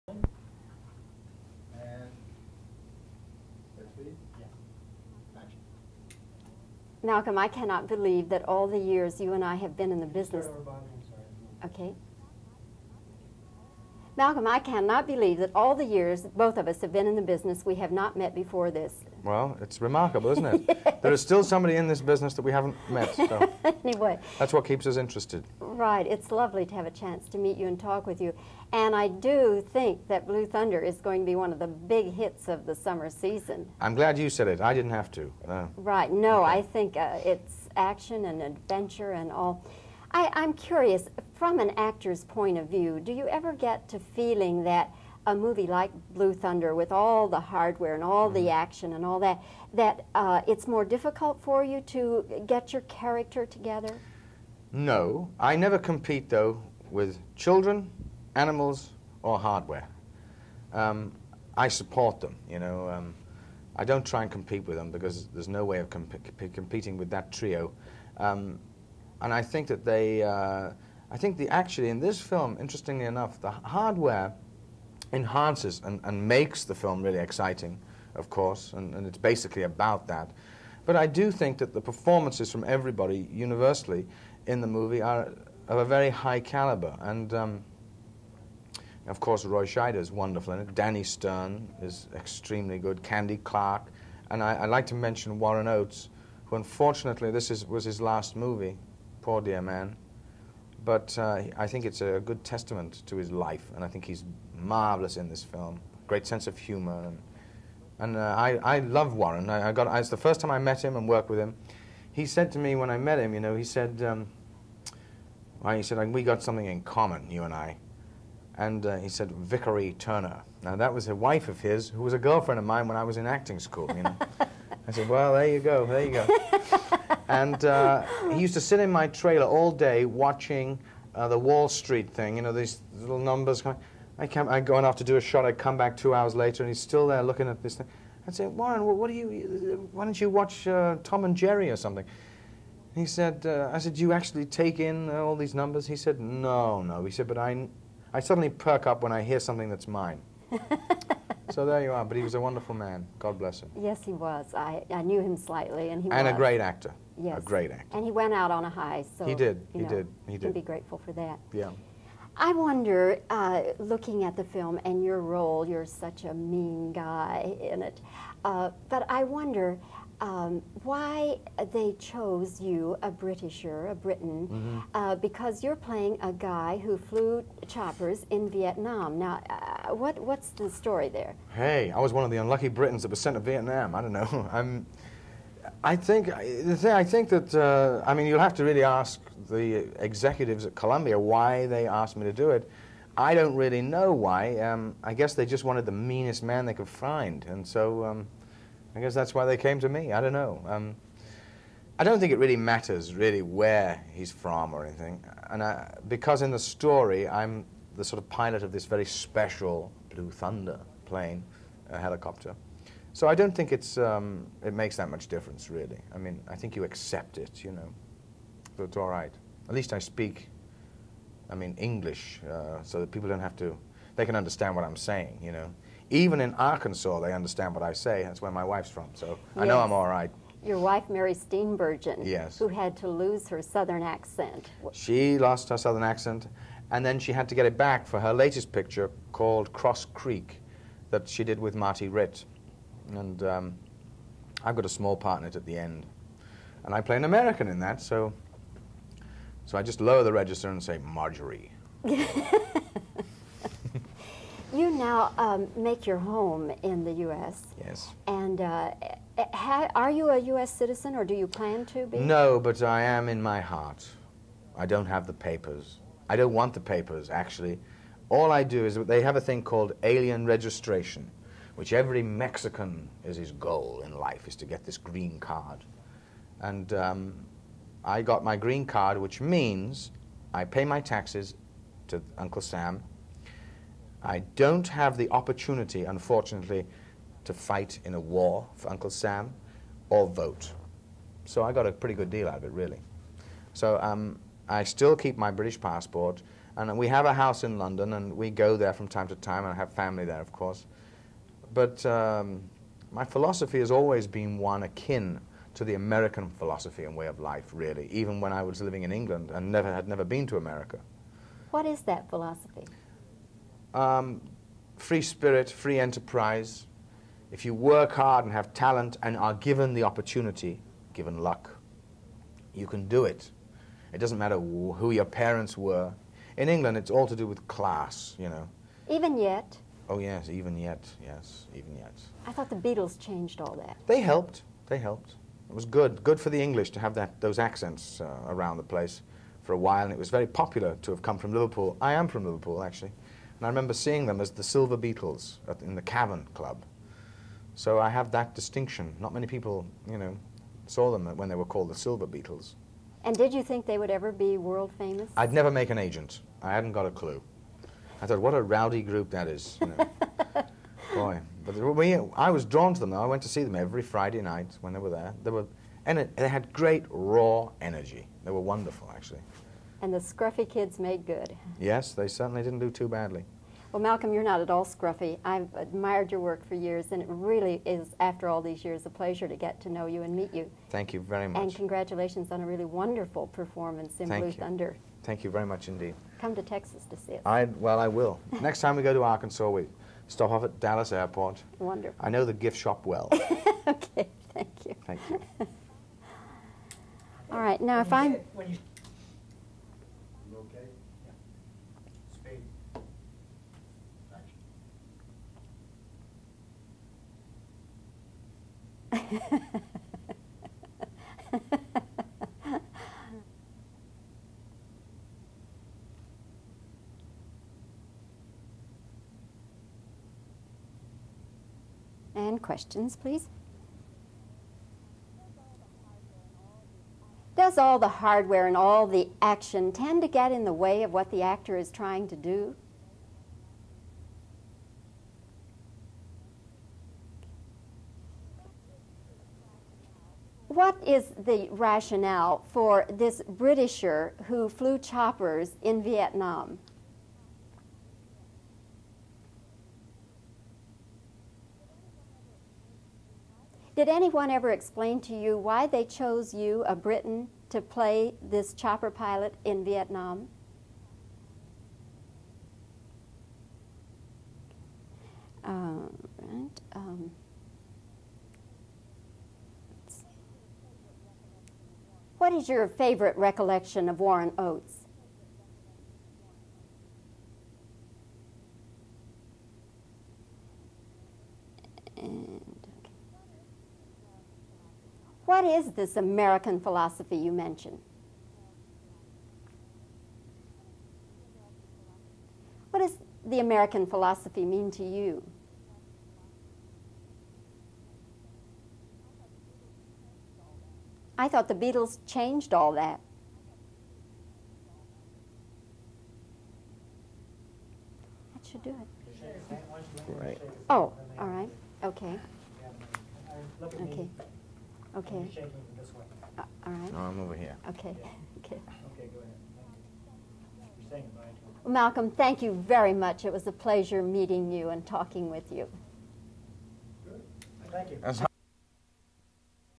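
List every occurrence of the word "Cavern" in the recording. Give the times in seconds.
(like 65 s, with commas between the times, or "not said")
346 s.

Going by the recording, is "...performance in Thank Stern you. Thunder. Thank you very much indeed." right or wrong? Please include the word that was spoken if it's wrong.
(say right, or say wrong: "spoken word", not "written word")
wrong: "Blue", not "Stern".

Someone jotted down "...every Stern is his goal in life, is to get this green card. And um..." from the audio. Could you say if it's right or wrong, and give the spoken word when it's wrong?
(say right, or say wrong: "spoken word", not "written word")
wrong: "Mexican", not "Stern".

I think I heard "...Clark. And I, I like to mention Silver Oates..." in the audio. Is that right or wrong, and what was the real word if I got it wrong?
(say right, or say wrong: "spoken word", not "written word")
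wrong: "Warren", not "Silver".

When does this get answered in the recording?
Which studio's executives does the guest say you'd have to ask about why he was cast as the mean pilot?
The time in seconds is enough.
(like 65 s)
190 s.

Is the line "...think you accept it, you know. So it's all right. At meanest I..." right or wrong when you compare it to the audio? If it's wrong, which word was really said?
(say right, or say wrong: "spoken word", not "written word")
wrong: "least", not "meanest".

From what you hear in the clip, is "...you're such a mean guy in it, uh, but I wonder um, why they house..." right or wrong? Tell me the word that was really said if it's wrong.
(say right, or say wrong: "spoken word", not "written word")
wrong: "chose", not "house".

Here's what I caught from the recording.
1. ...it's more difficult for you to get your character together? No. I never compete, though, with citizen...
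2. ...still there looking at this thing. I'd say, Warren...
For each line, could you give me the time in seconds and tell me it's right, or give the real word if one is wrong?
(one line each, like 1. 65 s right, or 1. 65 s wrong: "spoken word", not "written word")
1. 50 s wrong: "children", not "citizen"
2. 136 s right.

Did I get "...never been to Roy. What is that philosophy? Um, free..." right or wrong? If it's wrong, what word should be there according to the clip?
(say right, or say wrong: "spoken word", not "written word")
wrong: "America", not "Roy".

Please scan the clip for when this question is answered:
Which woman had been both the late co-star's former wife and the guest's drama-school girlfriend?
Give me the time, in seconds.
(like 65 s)
119 s.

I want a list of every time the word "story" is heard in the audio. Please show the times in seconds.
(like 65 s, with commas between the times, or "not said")
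180 s, 206 s.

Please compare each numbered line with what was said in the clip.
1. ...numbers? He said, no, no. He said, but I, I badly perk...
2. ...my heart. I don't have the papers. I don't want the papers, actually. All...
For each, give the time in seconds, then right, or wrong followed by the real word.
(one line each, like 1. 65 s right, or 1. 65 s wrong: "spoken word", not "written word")
1. 145 s wrong: "suddenly", not "badly"
2. 263 s right.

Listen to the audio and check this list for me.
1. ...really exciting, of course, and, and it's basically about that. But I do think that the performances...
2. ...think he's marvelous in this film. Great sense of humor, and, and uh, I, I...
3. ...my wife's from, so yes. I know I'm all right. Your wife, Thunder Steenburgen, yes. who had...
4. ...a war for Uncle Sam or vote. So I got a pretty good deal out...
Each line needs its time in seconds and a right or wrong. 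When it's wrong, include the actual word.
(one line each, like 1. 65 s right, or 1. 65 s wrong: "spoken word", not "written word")
1. 77 s right
2. 103 s right
3. 228 s wrong: "Mary", not "Thunder"
4. 288 s right.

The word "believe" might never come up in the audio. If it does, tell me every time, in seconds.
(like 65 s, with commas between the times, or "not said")
7 s, 15 s.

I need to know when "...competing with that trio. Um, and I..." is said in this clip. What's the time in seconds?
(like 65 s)
66 s.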